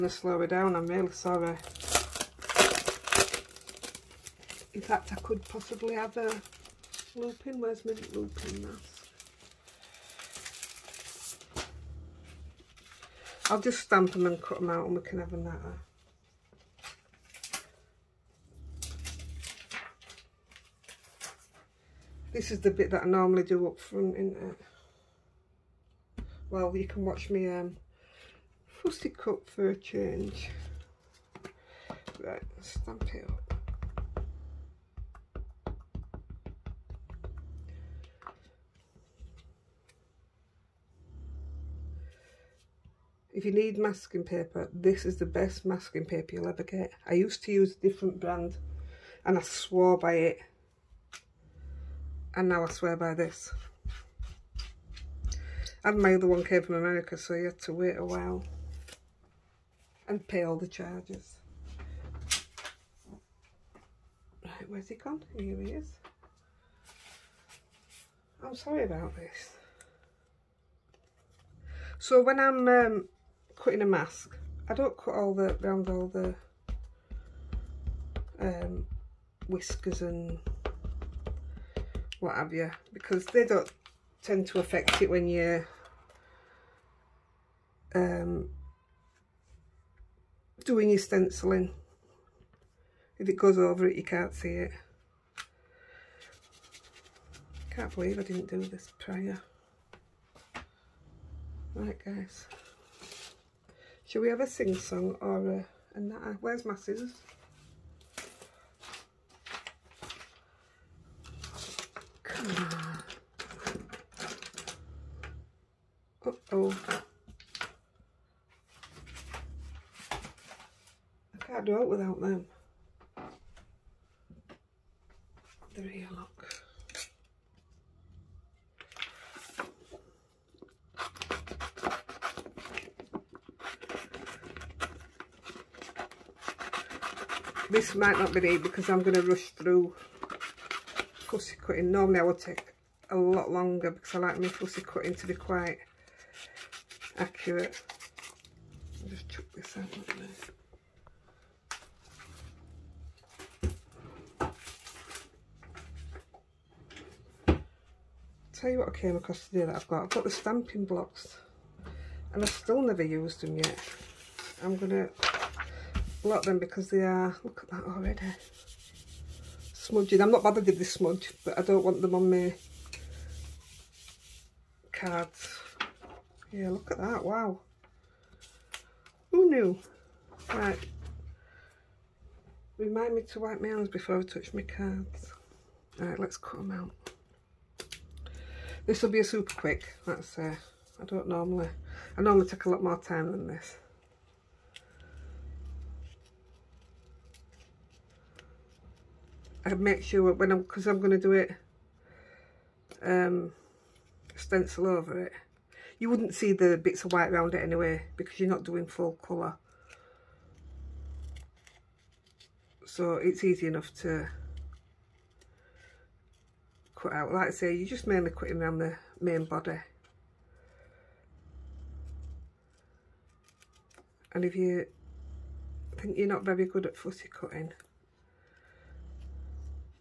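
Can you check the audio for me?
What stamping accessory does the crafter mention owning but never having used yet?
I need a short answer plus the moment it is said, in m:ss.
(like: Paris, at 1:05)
stamping blocks, at 2:40.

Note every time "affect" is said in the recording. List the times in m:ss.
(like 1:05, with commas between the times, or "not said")
1:24.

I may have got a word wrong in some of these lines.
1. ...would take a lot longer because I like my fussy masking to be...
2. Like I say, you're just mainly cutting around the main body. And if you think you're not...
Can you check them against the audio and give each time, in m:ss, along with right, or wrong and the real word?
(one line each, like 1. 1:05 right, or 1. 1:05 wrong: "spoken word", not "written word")
1. 2:22 wrong: "cutting", not "masking"
2. 3:37 right.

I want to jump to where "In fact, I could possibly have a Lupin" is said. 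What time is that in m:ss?
0:04.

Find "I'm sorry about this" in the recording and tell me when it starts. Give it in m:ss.
1:08.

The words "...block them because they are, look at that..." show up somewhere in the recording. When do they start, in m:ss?
2:46.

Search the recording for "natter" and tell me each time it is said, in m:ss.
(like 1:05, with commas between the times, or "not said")
0:15, 1:45.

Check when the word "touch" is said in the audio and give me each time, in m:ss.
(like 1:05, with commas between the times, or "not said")
3:04.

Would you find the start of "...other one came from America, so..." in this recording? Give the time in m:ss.
0:56.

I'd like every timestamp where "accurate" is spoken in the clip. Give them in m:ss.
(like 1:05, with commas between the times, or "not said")
2:27.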